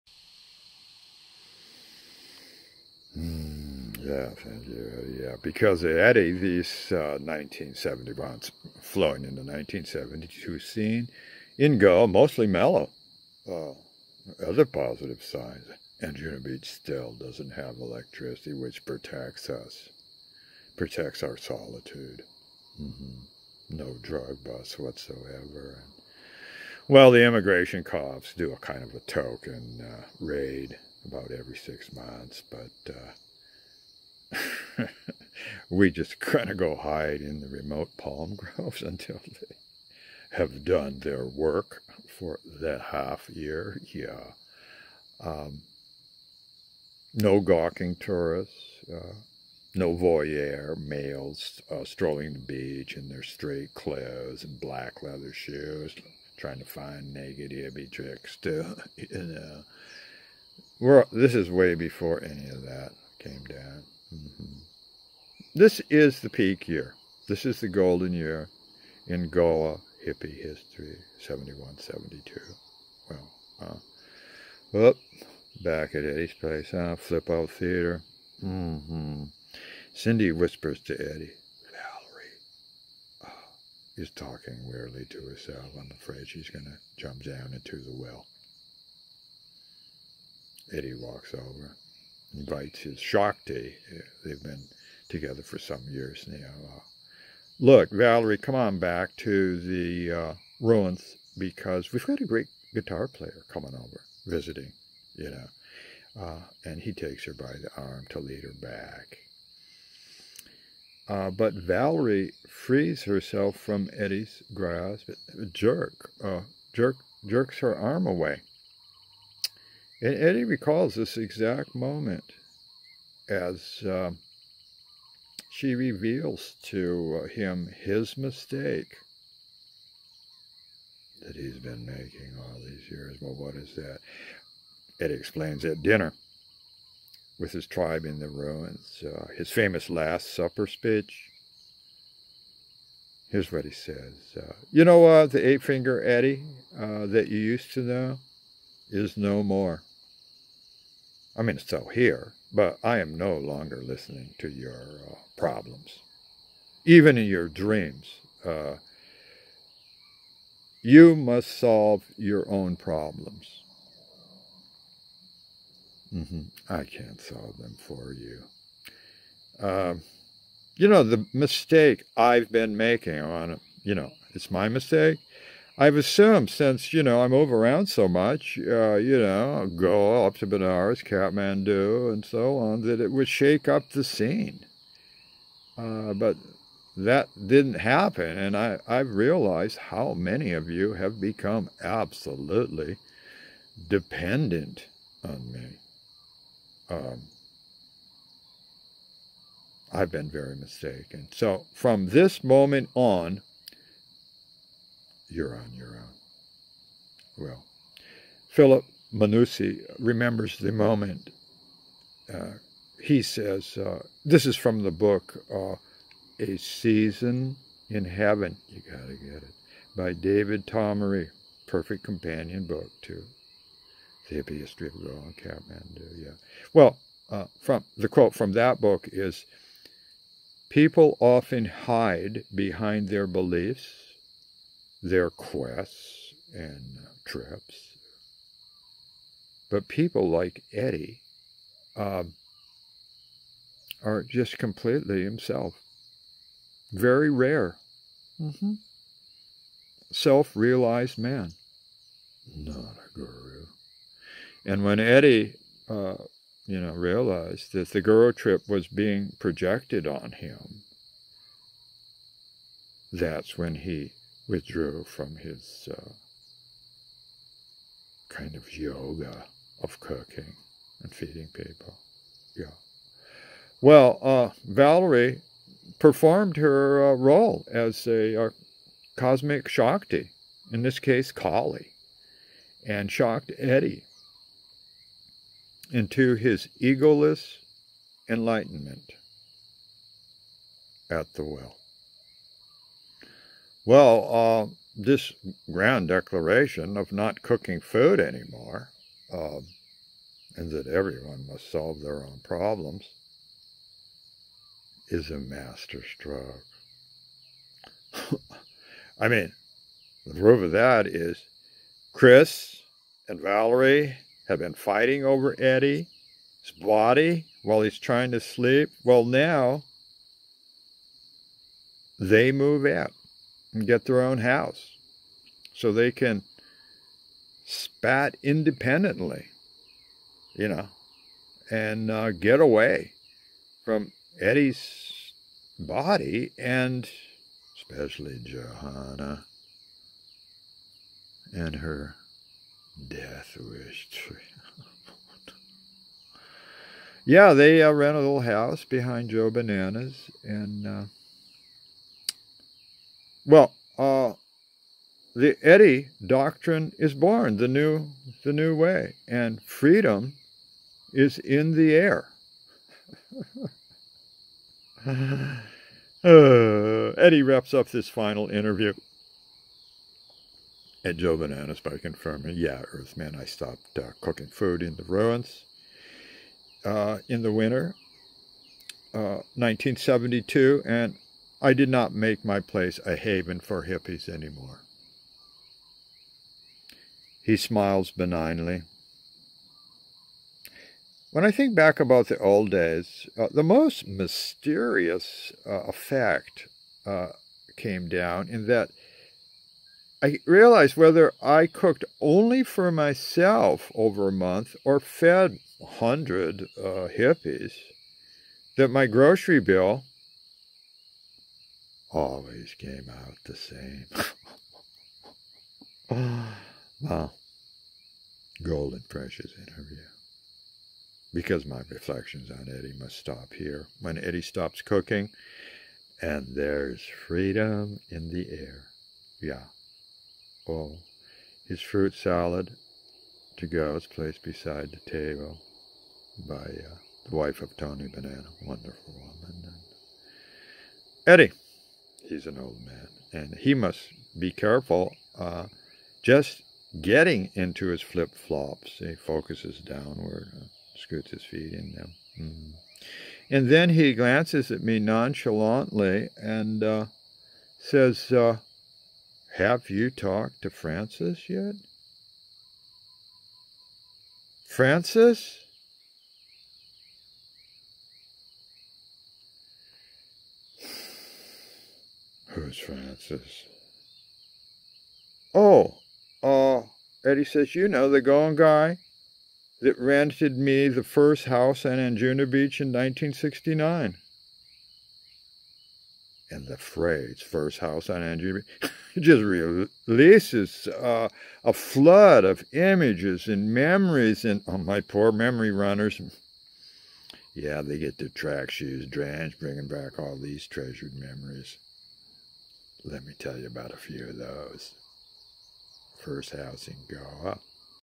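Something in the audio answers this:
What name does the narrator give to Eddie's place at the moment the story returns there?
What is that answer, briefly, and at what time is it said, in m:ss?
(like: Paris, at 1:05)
Flip Out Theater, at 1:16.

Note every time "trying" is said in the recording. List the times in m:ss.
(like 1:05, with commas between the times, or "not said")
0:56, 5:17.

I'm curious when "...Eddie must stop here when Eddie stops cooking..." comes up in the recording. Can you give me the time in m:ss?
7:02.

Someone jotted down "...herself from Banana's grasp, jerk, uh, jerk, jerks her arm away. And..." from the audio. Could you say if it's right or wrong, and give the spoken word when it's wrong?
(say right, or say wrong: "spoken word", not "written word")
wrong: "Eddie", not "Banana".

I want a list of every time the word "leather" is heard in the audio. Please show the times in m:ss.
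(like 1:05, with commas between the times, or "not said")
0:55.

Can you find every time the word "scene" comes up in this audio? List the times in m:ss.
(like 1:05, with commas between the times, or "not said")
0:10, 3:04.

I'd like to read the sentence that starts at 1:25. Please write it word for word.
I'm afraid she's going to jump down into the well.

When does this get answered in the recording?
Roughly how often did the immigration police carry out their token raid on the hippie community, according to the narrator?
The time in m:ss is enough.
0:31.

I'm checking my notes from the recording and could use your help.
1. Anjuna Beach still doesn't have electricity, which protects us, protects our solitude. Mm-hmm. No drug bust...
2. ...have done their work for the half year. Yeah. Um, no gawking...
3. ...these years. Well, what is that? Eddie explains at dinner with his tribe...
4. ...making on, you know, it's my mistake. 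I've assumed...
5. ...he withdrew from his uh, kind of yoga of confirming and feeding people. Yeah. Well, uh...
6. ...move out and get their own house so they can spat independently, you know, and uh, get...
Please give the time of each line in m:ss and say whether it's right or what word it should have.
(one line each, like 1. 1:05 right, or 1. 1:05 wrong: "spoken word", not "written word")
1. 0:16 right
2. 0:40 right
3. 2:12 right
4. 2:52 right
5. 4:23 wrong: "cooking", not "confirming"
6. 5:22 right.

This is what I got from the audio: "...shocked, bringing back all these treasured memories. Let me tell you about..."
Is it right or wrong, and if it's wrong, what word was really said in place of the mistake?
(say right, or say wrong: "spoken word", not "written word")
wrong: "drenched", not "shocked".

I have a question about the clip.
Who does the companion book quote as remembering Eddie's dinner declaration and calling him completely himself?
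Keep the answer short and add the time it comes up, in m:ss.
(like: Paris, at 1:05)
Philip Manucci, at 3:28.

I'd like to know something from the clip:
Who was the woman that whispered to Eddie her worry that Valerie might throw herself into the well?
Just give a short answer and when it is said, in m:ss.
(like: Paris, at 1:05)
Cindy, at 1:19.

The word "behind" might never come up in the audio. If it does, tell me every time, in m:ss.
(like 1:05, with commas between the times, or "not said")
3:52, 5:48.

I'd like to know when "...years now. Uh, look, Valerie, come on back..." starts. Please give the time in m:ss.
1:35.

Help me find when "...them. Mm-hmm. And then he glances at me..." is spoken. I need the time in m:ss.
7:31.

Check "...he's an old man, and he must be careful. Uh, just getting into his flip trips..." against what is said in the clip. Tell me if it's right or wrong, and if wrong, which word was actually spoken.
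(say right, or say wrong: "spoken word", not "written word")
wrong: "flops", not "trips".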